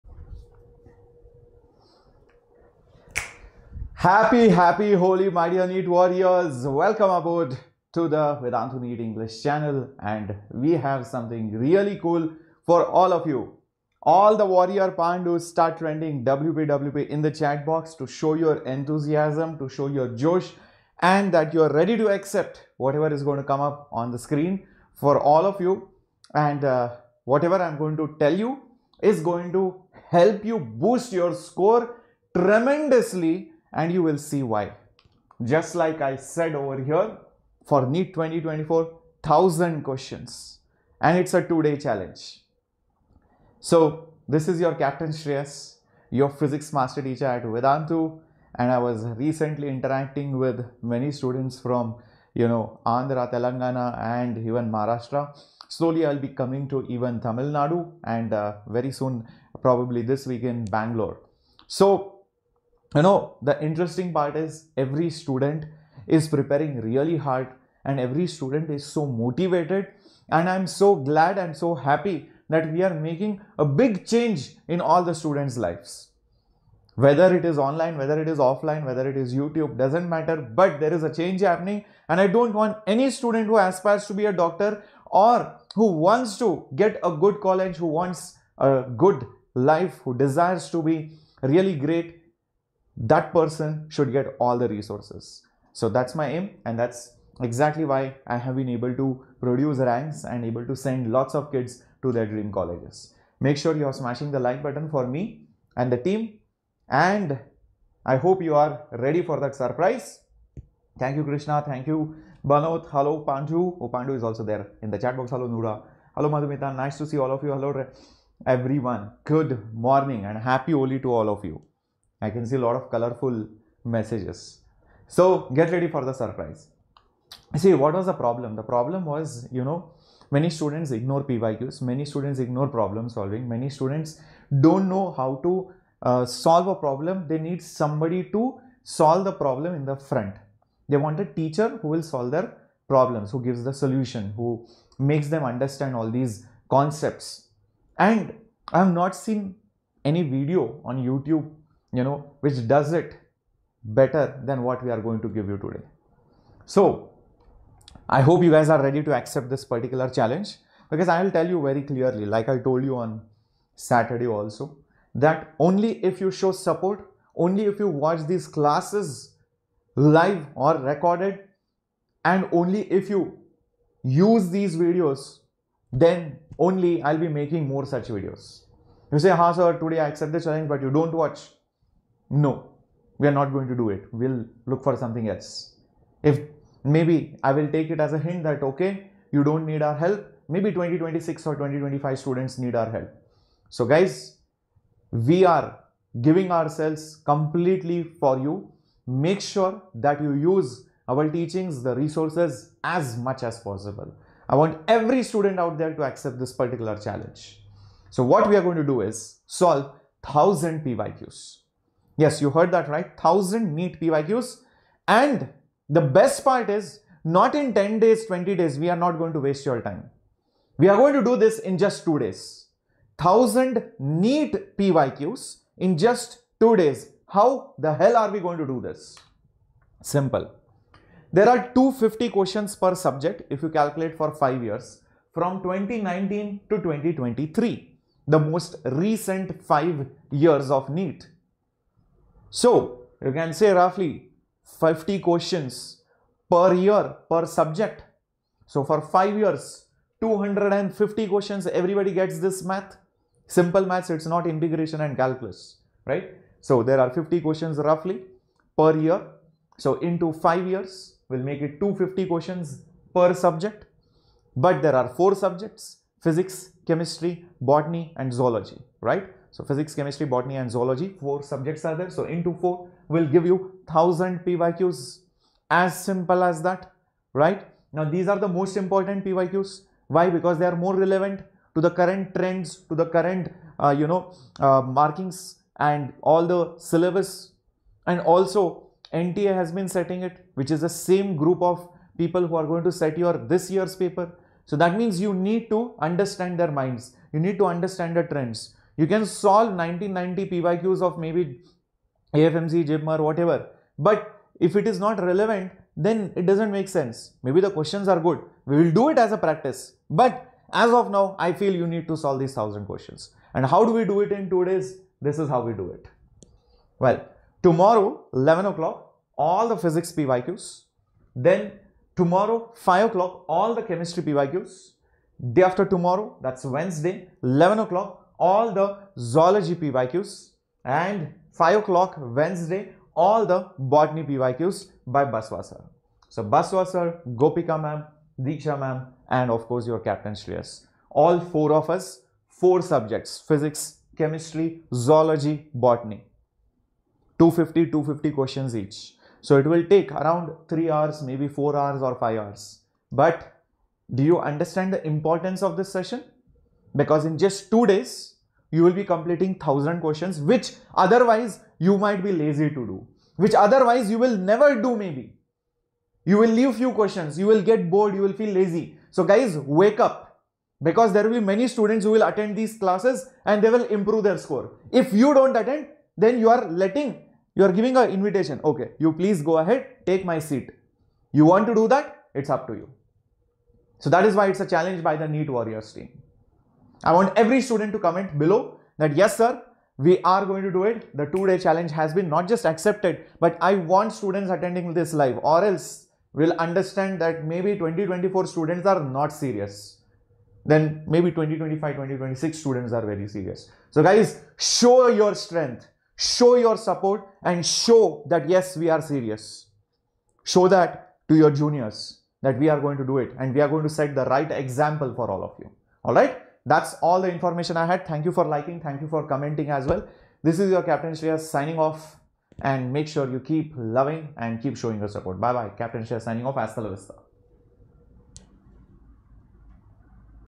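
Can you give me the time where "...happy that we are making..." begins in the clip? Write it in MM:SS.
01:11.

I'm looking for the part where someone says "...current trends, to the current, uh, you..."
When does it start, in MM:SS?
04:41.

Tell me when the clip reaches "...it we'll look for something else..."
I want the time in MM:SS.
03:03.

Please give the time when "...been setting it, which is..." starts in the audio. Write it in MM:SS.
04:49.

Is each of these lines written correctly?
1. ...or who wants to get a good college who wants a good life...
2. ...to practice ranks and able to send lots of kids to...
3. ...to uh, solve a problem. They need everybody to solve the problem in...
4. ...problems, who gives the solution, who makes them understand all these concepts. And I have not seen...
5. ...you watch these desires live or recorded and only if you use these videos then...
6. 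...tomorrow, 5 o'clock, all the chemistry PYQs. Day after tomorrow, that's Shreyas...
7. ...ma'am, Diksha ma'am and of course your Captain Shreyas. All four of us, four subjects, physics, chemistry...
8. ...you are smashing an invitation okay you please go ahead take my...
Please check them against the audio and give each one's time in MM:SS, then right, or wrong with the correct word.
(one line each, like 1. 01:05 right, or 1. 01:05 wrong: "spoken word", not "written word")
1. 01:25 right
2. 01:38 wrong: "produce", not "practice"
3. 02:15 wrong: "somebody", not "everybody"
4. 02:22 right
5. 02:47 wrong: "classes", not "desires"
6. 05:22 wrong: "Wednesday", not "Shreyas"
7. 05:37 right
8. 06:17 wrong: "giving", not "smashing".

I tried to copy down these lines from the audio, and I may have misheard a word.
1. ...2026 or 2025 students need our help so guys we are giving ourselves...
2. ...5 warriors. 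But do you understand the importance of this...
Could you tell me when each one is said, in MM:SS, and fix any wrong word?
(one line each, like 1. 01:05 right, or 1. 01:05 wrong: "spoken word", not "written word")
1. 03:10 right
2. 05:52 wrong: "hours", not "warriors".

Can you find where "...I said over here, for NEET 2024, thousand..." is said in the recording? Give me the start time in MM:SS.
00:36.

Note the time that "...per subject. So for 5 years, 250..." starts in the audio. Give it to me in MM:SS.
04:07.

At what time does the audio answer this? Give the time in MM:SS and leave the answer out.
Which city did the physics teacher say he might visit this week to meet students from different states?
01:00.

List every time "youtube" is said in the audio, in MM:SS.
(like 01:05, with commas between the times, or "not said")
01:19, 02:31.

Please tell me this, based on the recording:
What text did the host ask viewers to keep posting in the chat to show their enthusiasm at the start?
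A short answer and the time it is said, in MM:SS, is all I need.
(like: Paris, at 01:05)
WPWP, at 00:16.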